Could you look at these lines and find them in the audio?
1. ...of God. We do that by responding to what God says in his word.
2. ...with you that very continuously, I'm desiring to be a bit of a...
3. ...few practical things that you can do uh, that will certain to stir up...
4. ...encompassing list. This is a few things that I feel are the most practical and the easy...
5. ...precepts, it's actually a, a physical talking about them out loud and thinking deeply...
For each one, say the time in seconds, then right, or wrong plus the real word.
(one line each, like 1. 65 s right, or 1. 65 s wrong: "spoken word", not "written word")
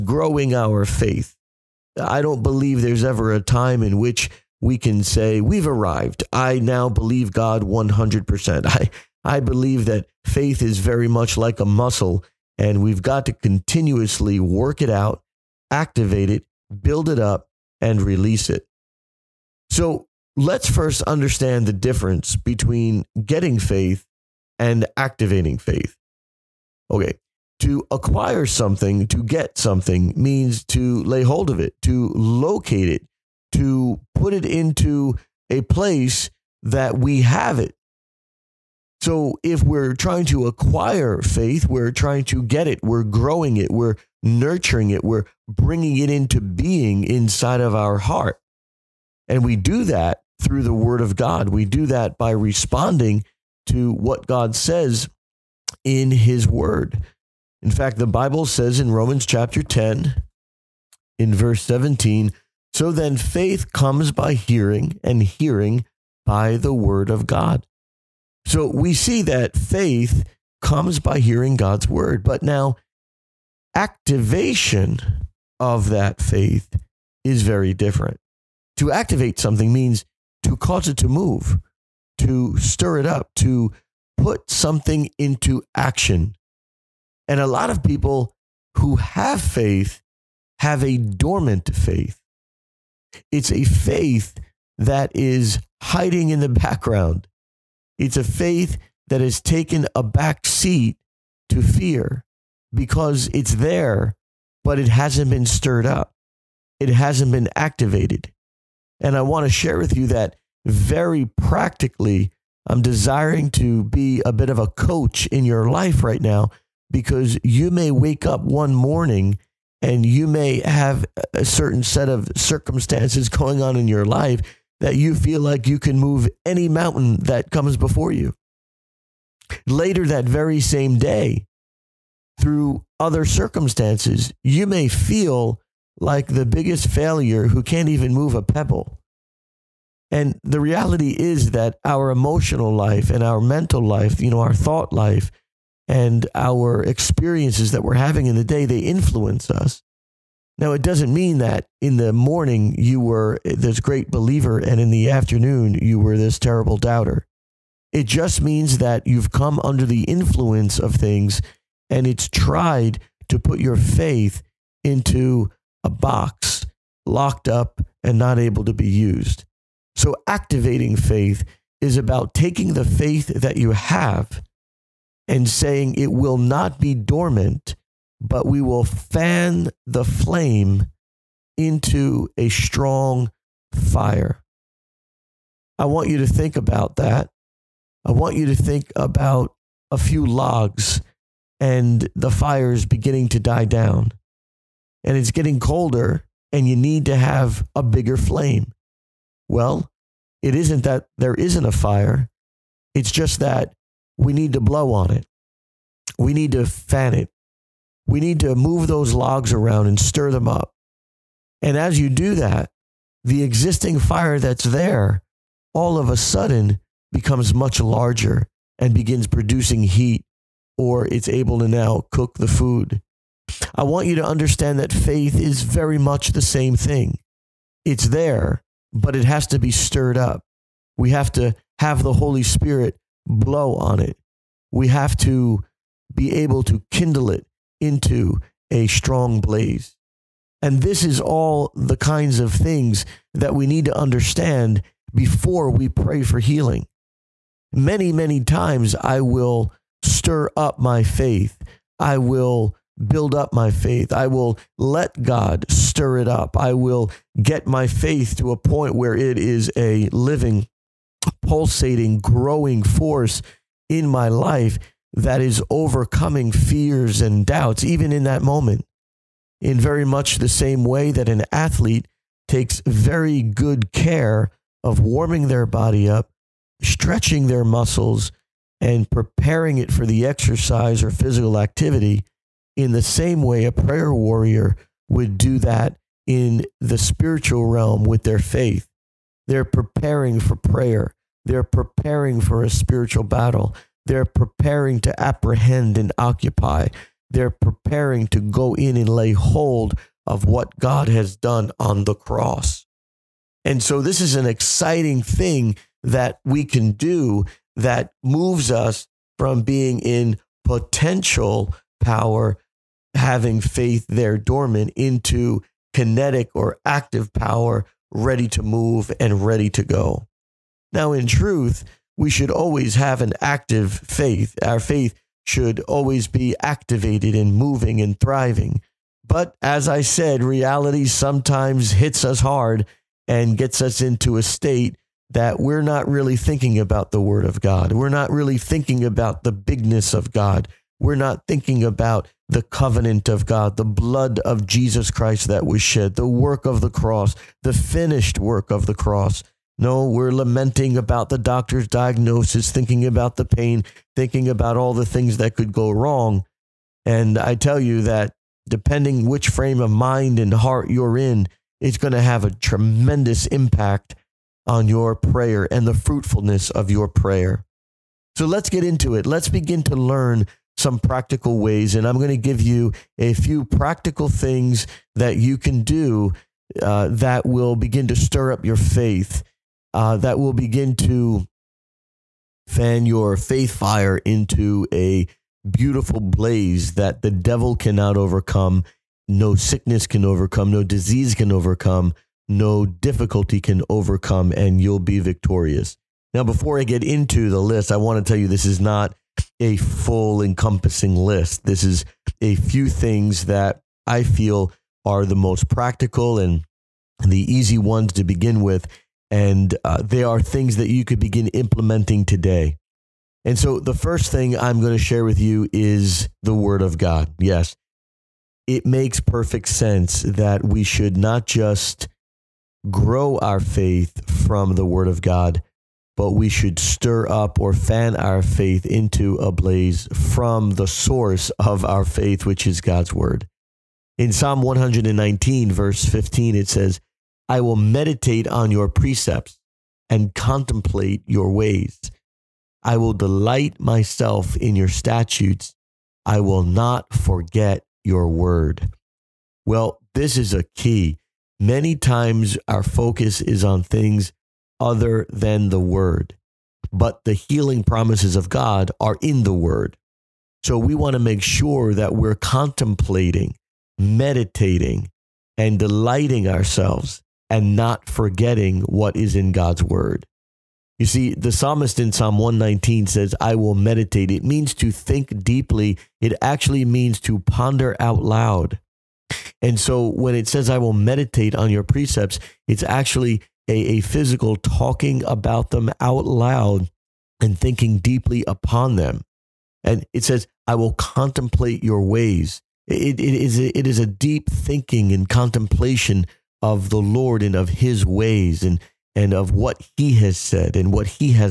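1. 51 s right
2. 109 s wrong: "practically", not "continuously"
3. 373 s wrong: "begin", not "certain"
4. 400 s right
5. 481 s right.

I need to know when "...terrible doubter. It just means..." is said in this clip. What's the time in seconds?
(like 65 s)
156 s.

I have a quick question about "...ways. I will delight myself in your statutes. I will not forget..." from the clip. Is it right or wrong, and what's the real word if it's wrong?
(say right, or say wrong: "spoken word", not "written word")
right.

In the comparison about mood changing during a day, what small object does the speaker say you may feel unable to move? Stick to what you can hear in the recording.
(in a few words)
a pebble.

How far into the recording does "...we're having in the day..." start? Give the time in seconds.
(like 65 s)
147 s.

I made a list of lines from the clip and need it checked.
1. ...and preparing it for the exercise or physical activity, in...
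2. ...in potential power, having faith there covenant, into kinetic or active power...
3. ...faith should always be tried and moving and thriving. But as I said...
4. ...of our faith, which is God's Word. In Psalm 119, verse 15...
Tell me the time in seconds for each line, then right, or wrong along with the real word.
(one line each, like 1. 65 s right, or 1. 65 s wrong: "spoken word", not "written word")
1. 278 s right
2. 310 s wrong: "dormant", not "covenant"
3. 324 s wrong: "activated", not "tried"
4. 431 s right.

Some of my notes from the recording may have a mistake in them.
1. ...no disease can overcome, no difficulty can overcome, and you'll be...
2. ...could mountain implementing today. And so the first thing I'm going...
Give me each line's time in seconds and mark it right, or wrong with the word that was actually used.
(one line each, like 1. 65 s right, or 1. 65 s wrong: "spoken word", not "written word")
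1. 390 s right
2. 411 s wrong: "begin", not "mountain".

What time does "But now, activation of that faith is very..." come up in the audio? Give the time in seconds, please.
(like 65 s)
72 s.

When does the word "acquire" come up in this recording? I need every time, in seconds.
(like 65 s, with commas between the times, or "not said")
27 s, 40 s.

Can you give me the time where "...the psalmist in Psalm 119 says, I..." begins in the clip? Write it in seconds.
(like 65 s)
471 s.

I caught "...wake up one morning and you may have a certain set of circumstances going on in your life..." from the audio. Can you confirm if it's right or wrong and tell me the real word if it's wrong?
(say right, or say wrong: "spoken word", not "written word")
right.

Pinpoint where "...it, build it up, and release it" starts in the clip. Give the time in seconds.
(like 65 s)
16 s.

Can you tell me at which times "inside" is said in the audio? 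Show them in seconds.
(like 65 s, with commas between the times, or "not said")
47 s.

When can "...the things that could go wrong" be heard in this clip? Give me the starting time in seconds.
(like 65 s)
354 s.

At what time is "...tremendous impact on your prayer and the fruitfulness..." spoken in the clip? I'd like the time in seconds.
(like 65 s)
362 s.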